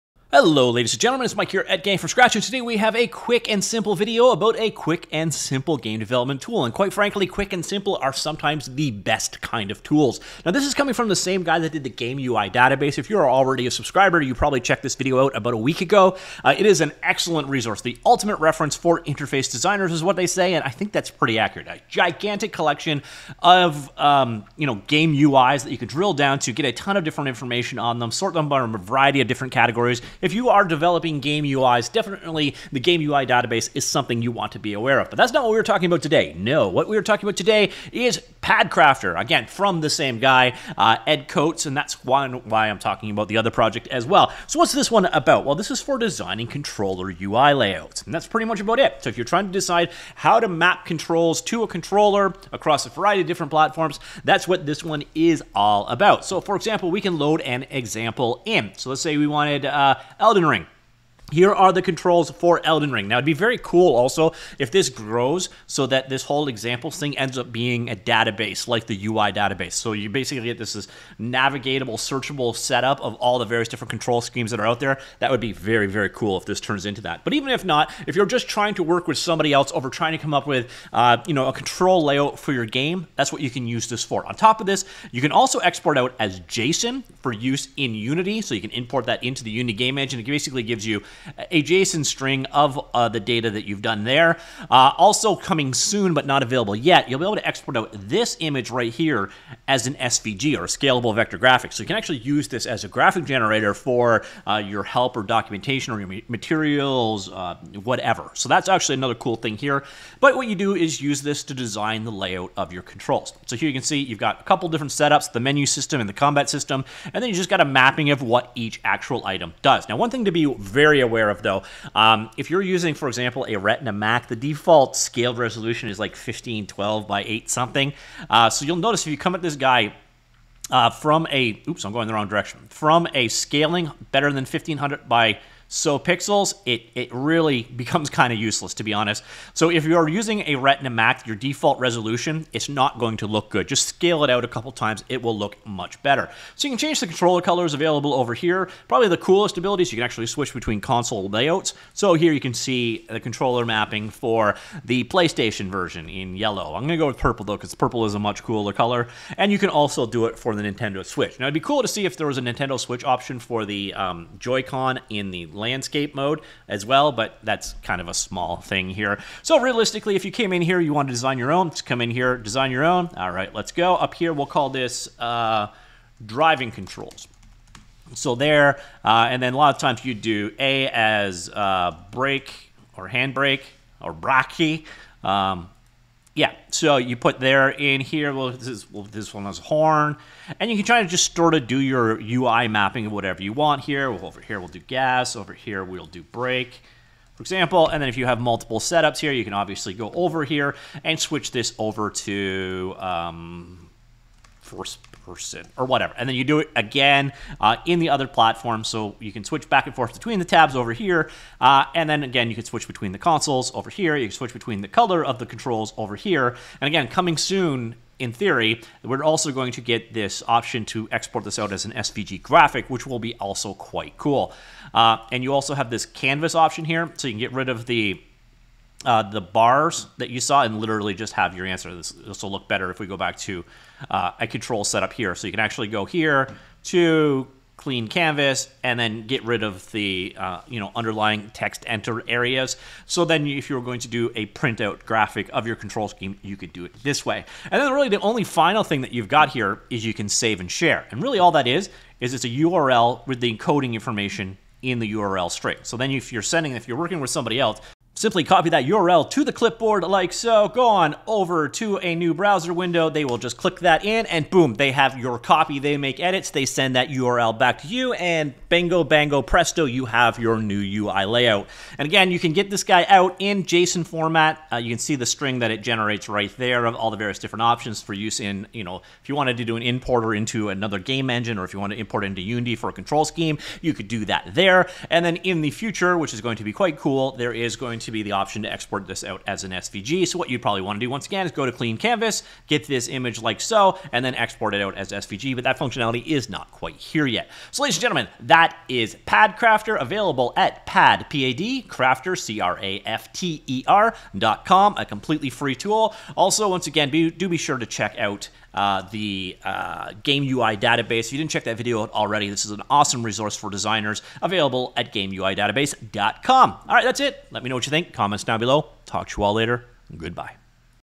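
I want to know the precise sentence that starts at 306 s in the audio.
Also, once again, be, do be sure to check out uh, the uh, Game UI database.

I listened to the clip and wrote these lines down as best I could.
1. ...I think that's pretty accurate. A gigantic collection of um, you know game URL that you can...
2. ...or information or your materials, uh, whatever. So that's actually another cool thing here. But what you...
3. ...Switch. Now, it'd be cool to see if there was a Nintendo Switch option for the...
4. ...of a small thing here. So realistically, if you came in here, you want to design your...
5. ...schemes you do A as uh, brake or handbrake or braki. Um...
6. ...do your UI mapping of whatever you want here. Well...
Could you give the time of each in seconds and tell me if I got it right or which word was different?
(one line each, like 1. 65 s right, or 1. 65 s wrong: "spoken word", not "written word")
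1. 20 s wrong: "UIs", not "URL"
2. 105 s wrong: "documentation", not "information"
3. 161 s right
4. 168 s right
5. 179 s wrong: "times", not "schemes"
6. 191 s right.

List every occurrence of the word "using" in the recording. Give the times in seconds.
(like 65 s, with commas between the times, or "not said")
122 s, 140 s.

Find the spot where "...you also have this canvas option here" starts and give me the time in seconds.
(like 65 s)
225 s.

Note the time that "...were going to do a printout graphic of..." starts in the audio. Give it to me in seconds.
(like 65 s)
243 s.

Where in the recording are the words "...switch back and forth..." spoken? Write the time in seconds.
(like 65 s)
209 s.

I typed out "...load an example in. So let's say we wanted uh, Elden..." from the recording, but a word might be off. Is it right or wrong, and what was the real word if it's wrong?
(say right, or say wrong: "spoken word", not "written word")
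right.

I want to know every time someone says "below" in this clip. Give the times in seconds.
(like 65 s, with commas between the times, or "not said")
318 s.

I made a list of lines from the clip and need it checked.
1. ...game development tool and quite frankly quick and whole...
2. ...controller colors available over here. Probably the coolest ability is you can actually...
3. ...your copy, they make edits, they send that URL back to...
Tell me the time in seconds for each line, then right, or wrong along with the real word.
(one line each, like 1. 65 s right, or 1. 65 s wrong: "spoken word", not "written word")
1. 5 s wrong: "simple", not "whole"
2. 147 s right
3. 265 s right.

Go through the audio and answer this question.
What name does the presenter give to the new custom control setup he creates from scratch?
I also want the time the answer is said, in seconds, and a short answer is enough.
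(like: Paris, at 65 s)
driving controls, at 176 s.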